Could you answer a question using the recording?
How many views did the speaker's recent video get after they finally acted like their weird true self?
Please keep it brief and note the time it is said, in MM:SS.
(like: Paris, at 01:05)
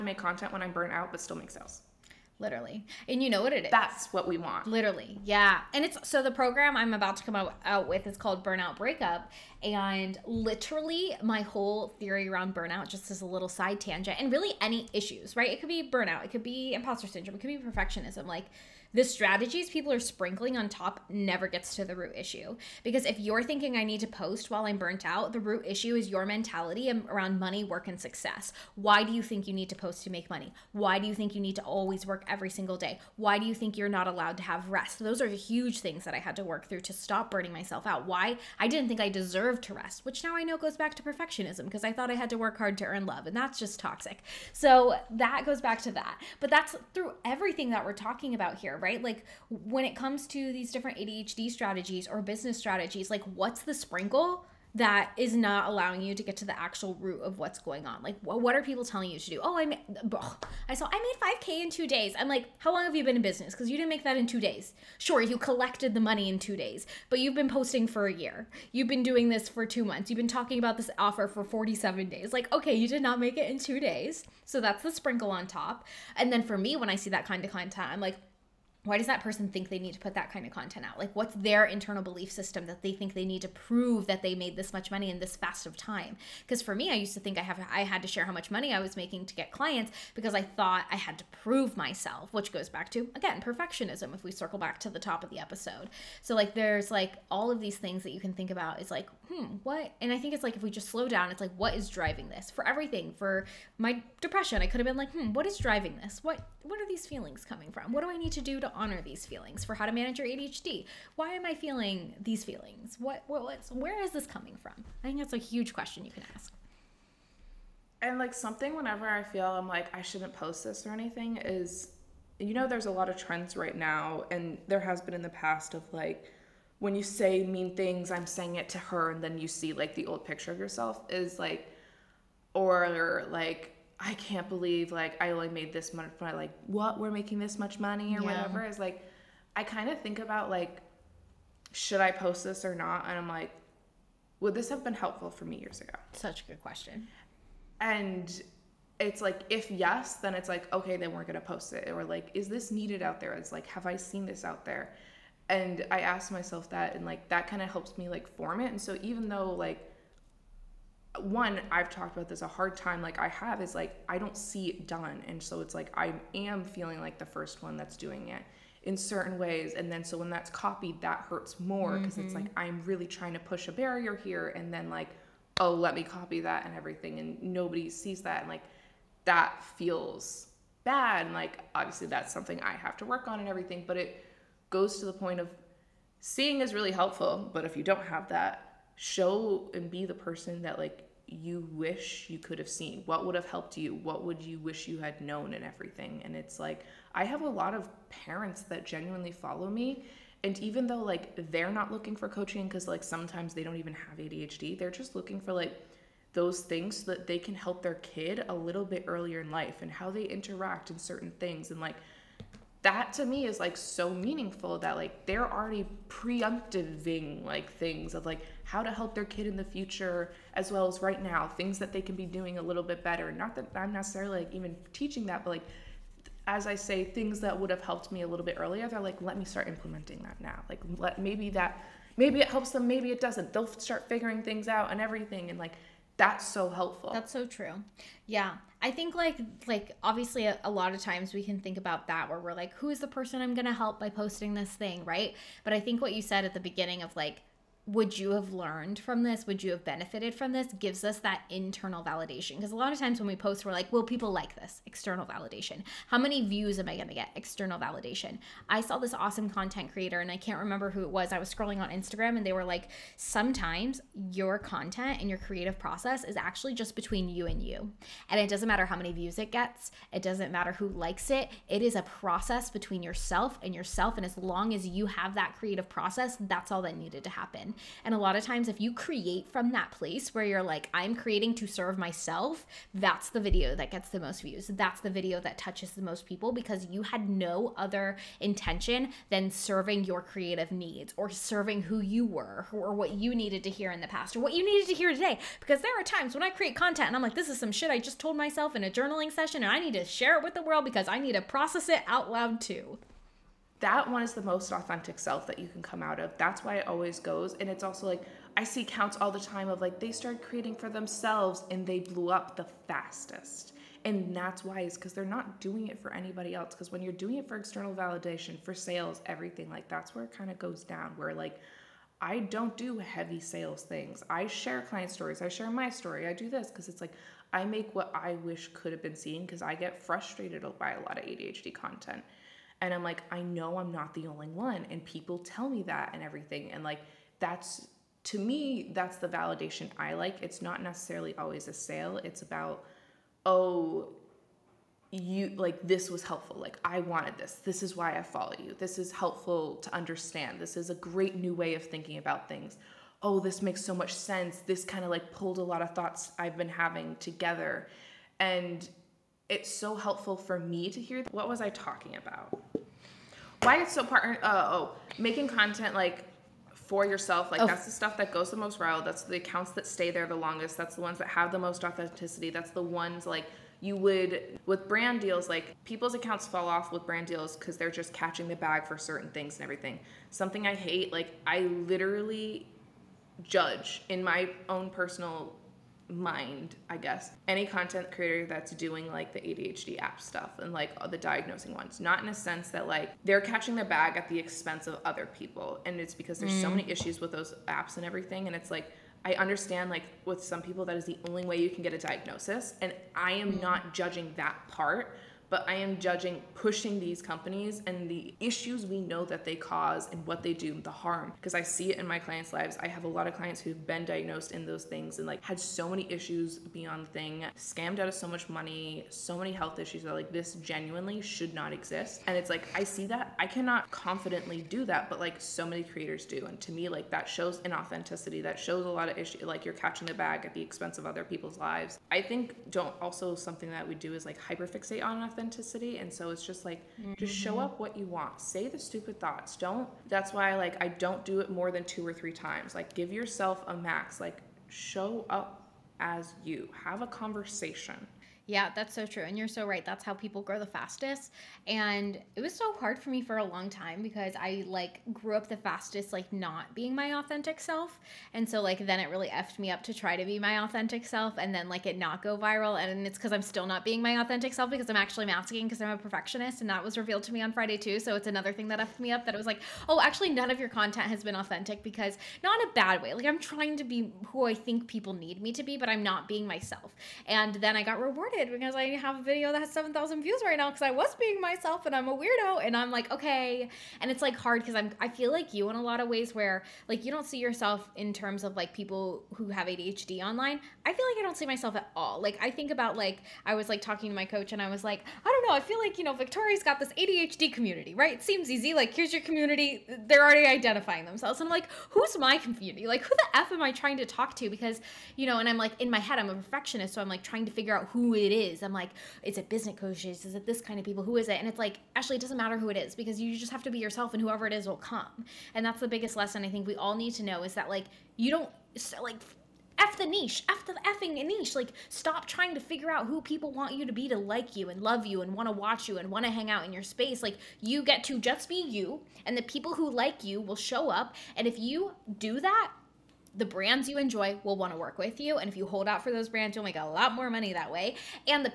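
7,000, at 07:59.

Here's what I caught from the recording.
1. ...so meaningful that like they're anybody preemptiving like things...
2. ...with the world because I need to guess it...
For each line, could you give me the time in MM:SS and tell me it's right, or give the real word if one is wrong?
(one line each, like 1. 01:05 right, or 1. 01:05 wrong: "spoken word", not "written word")
1. 03:33 wrong: "already", not "anybody"
2. 05:00 wrong: "process", not "guess".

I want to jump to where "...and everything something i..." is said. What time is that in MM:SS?
06:19.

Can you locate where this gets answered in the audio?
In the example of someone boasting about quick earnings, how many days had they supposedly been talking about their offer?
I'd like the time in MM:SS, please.
01:11.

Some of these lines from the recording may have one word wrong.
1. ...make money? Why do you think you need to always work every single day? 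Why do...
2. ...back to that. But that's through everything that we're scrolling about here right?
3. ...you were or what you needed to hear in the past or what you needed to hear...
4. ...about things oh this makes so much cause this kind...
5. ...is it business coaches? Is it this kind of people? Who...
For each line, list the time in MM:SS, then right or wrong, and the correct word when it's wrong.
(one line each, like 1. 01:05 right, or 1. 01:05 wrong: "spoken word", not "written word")
1. 00:30 right
2. 00:45 wrong: "talking", not "scrolling"
3. 04:52 right
4. 05:52 wrong: "sense", not "cause"
5. 08:29 right.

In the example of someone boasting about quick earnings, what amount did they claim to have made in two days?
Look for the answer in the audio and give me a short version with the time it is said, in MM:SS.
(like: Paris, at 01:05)
5K, at 01:01.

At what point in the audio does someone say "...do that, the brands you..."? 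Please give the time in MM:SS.
08:52.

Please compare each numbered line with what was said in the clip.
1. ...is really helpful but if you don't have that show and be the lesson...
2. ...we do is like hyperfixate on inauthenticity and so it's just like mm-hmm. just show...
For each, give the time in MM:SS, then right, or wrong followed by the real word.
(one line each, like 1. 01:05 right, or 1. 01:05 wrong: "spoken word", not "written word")
1. 03:06 wrong: "person", not "lesson"
2. 07:13 wrong: "authenticity", not "inauthenticity".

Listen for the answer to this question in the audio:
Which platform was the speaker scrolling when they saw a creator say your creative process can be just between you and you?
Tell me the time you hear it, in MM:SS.
04:21.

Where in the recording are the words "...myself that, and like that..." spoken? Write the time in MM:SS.
02:36.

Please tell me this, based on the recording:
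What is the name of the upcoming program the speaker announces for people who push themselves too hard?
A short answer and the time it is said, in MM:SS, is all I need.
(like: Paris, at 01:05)
Burnout Breakup, at 00:08.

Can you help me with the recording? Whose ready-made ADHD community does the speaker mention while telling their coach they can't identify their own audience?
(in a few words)
Victoria.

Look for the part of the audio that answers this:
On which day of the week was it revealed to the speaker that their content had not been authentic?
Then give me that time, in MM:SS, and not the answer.
07:47.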